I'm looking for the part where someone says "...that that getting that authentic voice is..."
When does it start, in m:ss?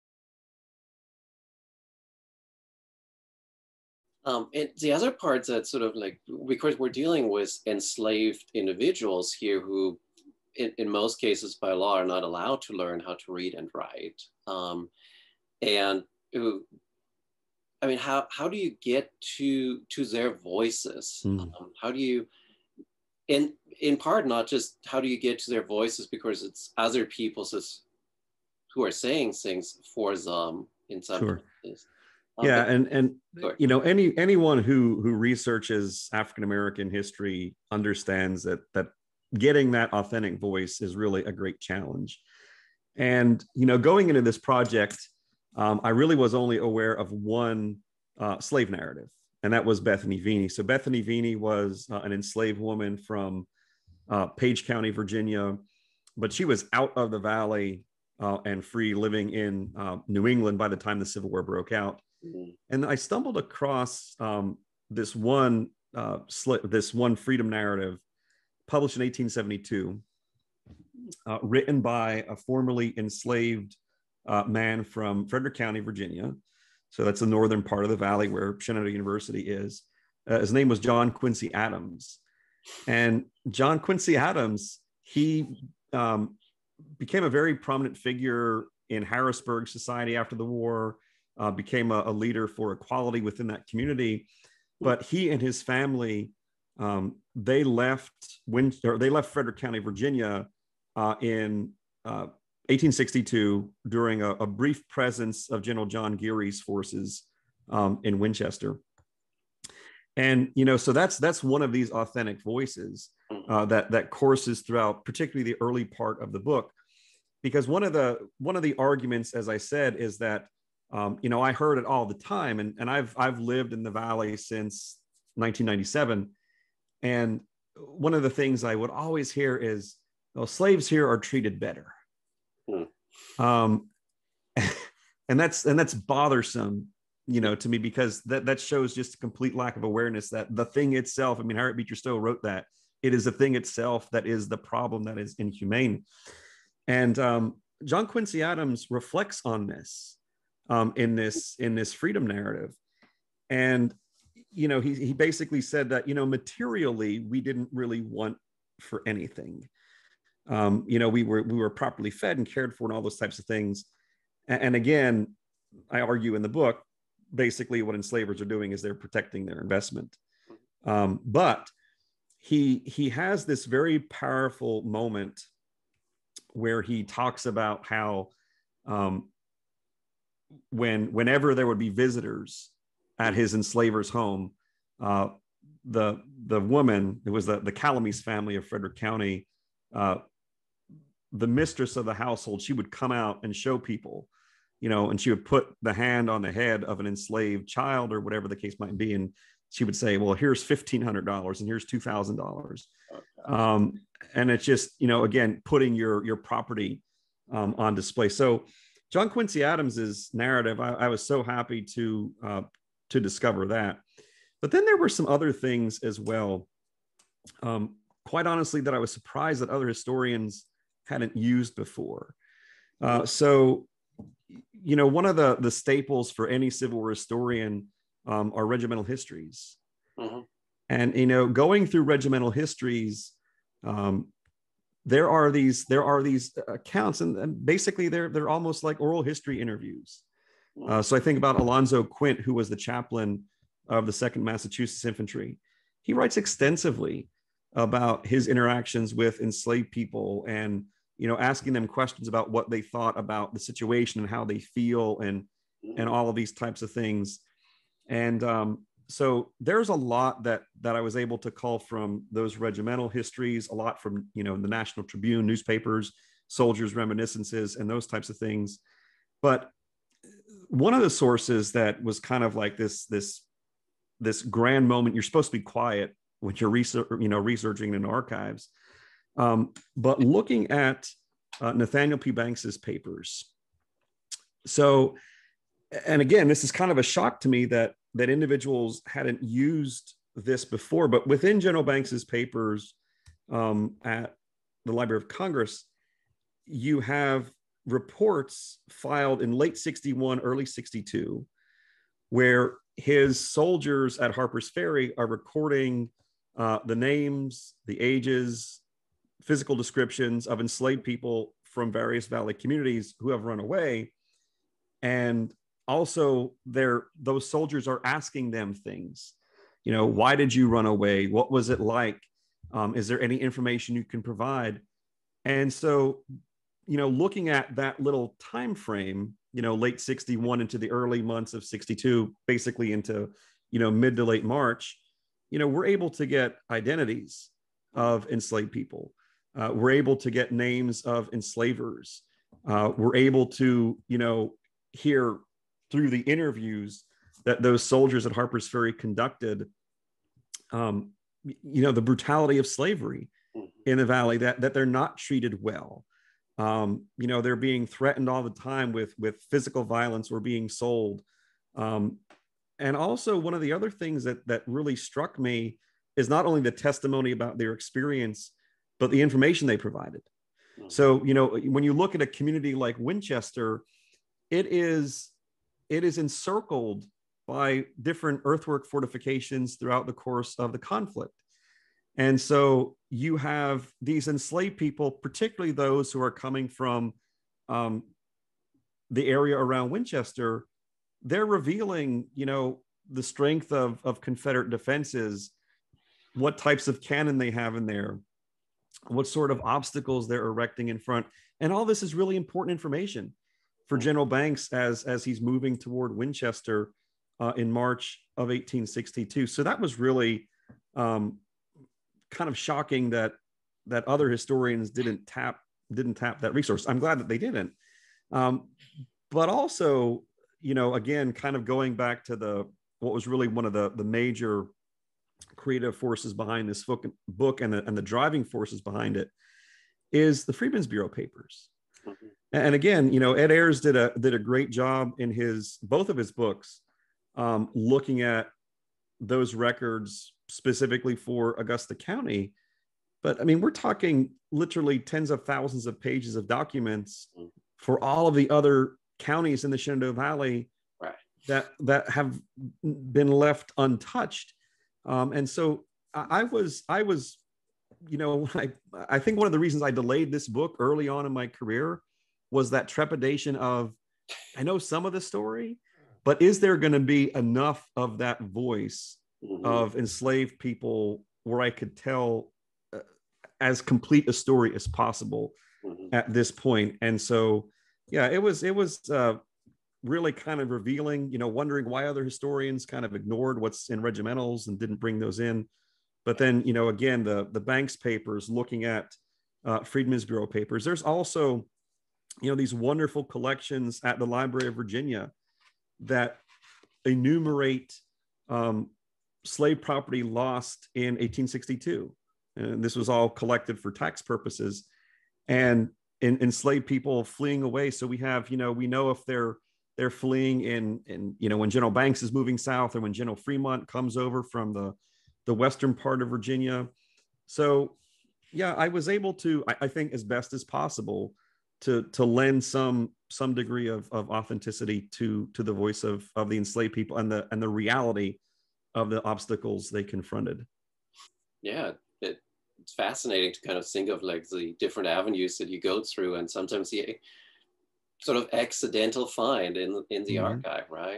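0:38.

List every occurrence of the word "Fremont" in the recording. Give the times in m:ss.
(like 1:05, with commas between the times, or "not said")
8:33.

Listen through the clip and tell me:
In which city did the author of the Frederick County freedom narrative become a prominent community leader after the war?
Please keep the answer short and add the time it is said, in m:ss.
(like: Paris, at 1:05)
Harrisburg, at 1:29.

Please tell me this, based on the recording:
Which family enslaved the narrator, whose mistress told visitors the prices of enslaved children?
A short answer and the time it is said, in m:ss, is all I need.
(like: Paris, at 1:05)
Calamese, at 3:07.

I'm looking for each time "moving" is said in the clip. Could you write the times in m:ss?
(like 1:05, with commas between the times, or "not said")
6:45, 8:32.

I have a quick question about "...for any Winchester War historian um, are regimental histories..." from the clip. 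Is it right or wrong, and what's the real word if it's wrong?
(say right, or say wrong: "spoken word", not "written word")
wrong: "Civil", not "Winchester".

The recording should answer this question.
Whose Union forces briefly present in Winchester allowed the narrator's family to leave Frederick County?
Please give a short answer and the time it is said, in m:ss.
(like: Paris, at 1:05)
General John Geary, at 1:45.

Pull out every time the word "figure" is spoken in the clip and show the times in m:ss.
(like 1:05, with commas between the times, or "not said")
1:27.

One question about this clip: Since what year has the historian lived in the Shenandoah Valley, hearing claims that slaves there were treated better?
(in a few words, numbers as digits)
1997.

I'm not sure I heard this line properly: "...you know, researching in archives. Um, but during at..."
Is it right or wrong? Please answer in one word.
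wrong.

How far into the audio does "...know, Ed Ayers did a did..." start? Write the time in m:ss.
7:13.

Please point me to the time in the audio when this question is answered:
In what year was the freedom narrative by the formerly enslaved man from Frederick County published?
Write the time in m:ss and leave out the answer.
1:09.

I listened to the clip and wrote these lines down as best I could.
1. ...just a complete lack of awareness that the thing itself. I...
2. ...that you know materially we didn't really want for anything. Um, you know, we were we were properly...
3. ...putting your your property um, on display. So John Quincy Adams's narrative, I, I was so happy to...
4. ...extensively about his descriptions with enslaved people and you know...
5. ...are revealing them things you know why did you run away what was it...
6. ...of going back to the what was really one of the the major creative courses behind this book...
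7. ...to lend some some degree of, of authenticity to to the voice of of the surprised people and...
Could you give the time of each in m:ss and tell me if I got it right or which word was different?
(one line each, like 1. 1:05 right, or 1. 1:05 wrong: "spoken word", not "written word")
1. 2:18 right
2. 2:35 right
3. 3:25 right
4. 4:06 wrong: "interactions", not "descriptions"
5. 5:17 wrong: "asking", not "revealing"
6. 7:01 wrong: "forces", not "courses"
7. 8:42 wrong: "enslaved", not "surprised".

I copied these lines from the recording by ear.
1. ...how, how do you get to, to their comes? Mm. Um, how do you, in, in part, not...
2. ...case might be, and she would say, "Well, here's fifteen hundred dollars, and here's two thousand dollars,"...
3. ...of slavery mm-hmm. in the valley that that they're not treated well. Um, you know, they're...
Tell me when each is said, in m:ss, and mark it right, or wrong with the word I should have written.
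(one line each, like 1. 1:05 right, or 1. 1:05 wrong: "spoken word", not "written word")
1. 0:17 wrong: "voices", not "comes"
2. 3:18 right
3. 5:52 right.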